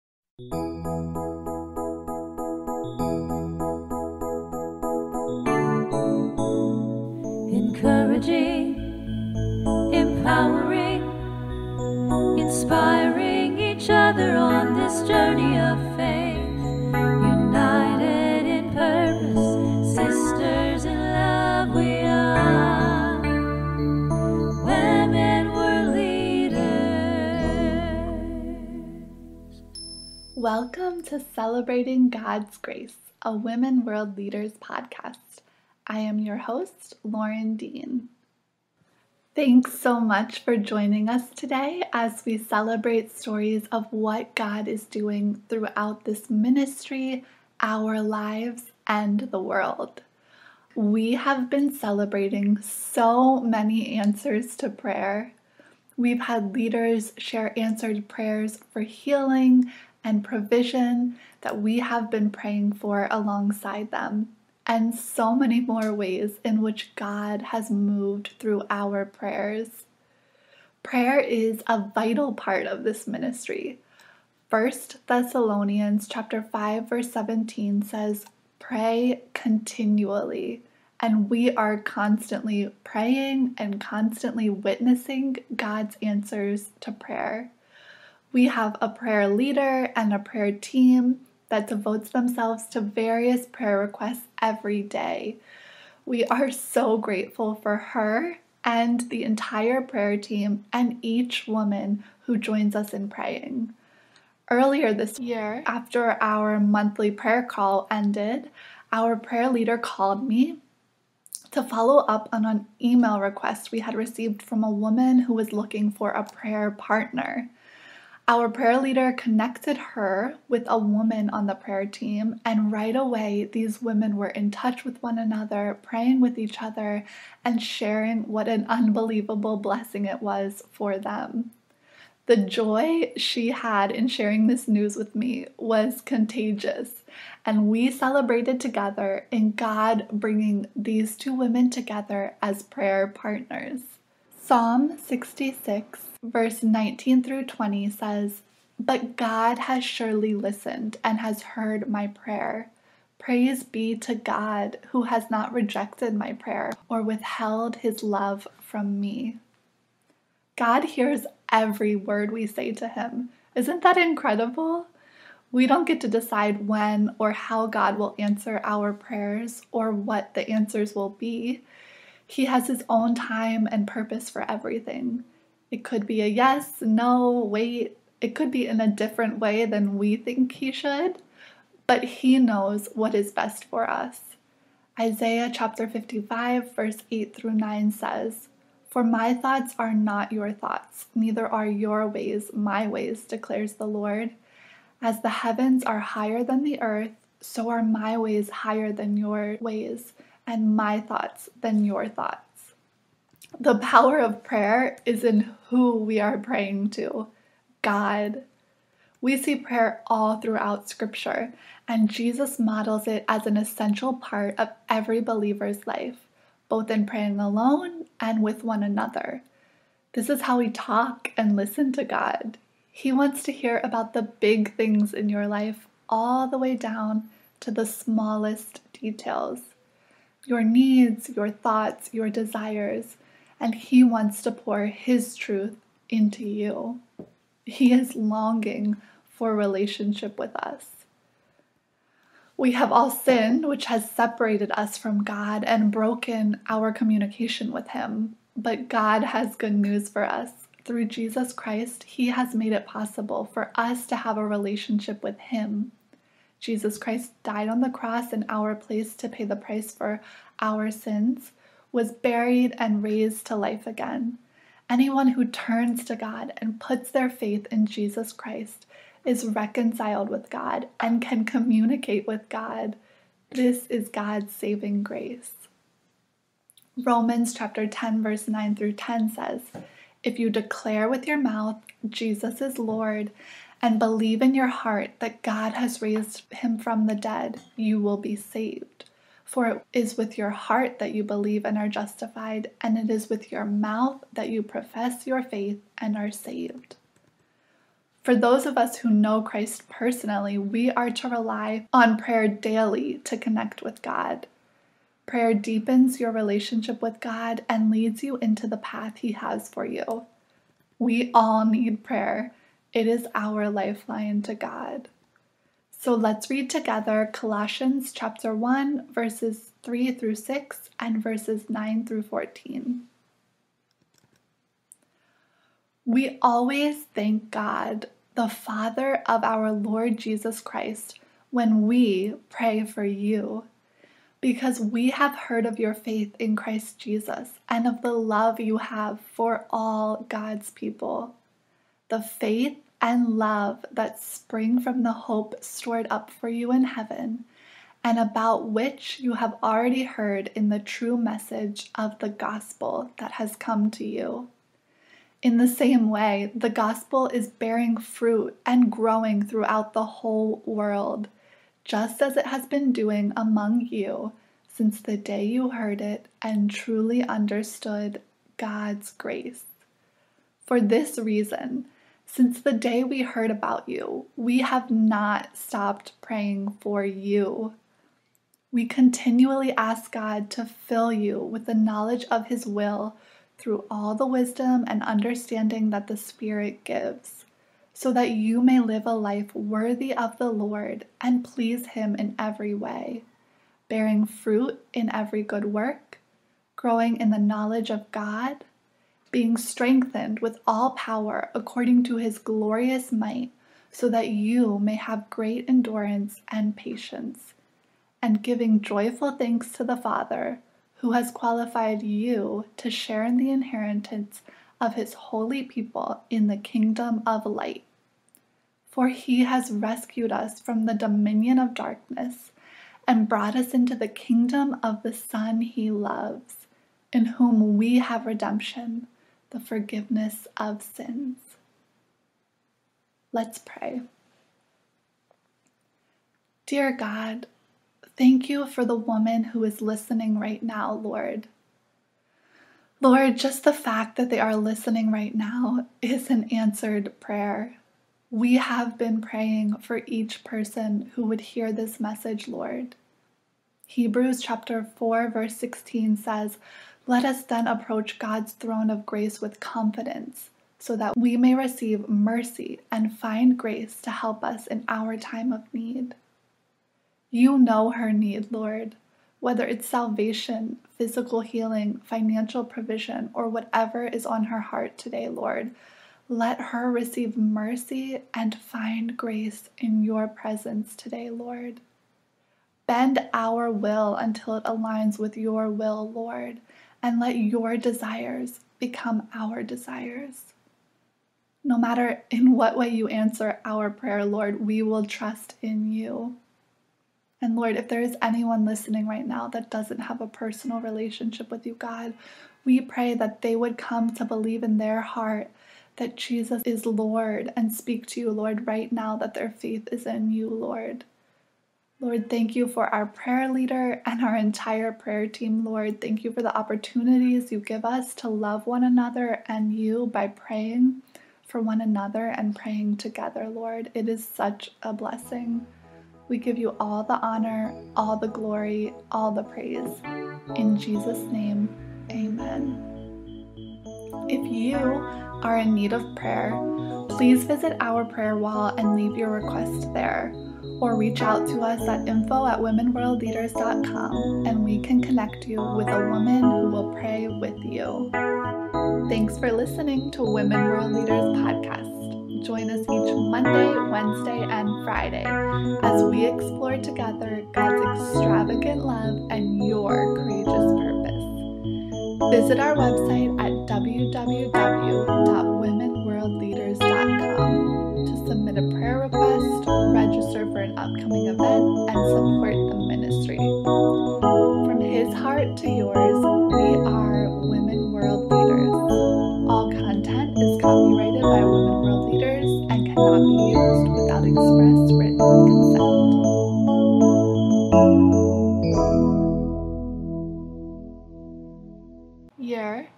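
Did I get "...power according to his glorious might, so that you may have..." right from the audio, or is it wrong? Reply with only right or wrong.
right.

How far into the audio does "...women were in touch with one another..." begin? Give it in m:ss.
2:03.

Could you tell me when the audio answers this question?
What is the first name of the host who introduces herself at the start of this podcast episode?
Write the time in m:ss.
0:37.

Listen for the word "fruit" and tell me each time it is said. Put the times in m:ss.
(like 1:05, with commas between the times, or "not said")
5:57, 6:34.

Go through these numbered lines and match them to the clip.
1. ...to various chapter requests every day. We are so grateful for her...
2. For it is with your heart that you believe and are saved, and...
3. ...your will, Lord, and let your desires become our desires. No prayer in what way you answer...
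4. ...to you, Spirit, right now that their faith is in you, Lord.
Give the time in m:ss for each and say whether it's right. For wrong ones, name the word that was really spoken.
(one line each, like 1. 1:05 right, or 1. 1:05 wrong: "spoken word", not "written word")
1. 1:32 wrong: "prayer", not "chapter"
2. 4:49 wrong: "justified", not "saved"
3. 8:05 wrong: "matter", not "prayer"
4. 8:28 wrong: "Lord", not "Spirit".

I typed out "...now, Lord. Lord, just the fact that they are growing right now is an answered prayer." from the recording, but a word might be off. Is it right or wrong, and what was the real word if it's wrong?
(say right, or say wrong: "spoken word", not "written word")
wrong: "listening", not "growing".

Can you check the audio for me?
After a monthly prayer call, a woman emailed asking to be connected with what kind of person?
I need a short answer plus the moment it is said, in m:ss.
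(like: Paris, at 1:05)
A prayer partner, at 1:56.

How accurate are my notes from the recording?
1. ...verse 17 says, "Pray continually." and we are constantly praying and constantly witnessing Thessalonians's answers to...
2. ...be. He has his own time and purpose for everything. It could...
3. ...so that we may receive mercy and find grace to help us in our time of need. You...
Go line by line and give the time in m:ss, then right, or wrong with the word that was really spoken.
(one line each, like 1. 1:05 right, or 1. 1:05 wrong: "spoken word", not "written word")
1. 1:16 wrong: "God", not "Thessalonians"
2. 2:51 right
3. 7:40 right.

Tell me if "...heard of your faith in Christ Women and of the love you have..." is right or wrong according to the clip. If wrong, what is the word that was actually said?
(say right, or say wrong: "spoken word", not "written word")
wrong: "Jesus", not "Women".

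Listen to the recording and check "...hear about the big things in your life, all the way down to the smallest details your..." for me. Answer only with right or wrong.
right.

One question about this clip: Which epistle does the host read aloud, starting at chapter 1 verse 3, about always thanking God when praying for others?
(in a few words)
Colossians.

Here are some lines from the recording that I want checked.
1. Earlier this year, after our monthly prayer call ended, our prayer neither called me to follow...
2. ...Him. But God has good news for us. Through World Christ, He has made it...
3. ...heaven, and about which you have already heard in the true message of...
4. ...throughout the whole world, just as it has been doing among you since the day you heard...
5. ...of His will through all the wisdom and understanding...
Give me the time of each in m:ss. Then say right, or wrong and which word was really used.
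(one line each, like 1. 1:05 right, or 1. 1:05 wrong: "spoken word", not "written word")
1. 1:44 wrong: "leader", not "neither"
2. 4:07 wrong: "Jesus", not "World"
3. 5:46 right
4. 5:59 right
5. 6:22 right.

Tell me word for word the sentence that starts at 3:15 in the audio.
As the heavens are higher than the earth, so are my ways higher than your ways, and my thoughts than your thoughts.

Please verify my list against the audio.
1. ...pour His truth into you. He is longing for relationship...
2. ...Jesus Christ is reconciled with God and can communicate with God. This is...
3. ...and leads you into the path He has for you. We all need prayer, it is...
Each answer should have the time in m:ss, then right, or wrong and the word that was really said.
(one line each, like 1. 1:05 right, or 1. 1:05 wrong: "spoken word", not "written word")
1. 3:54 right
2. 4:27 right
3. 5:07 right.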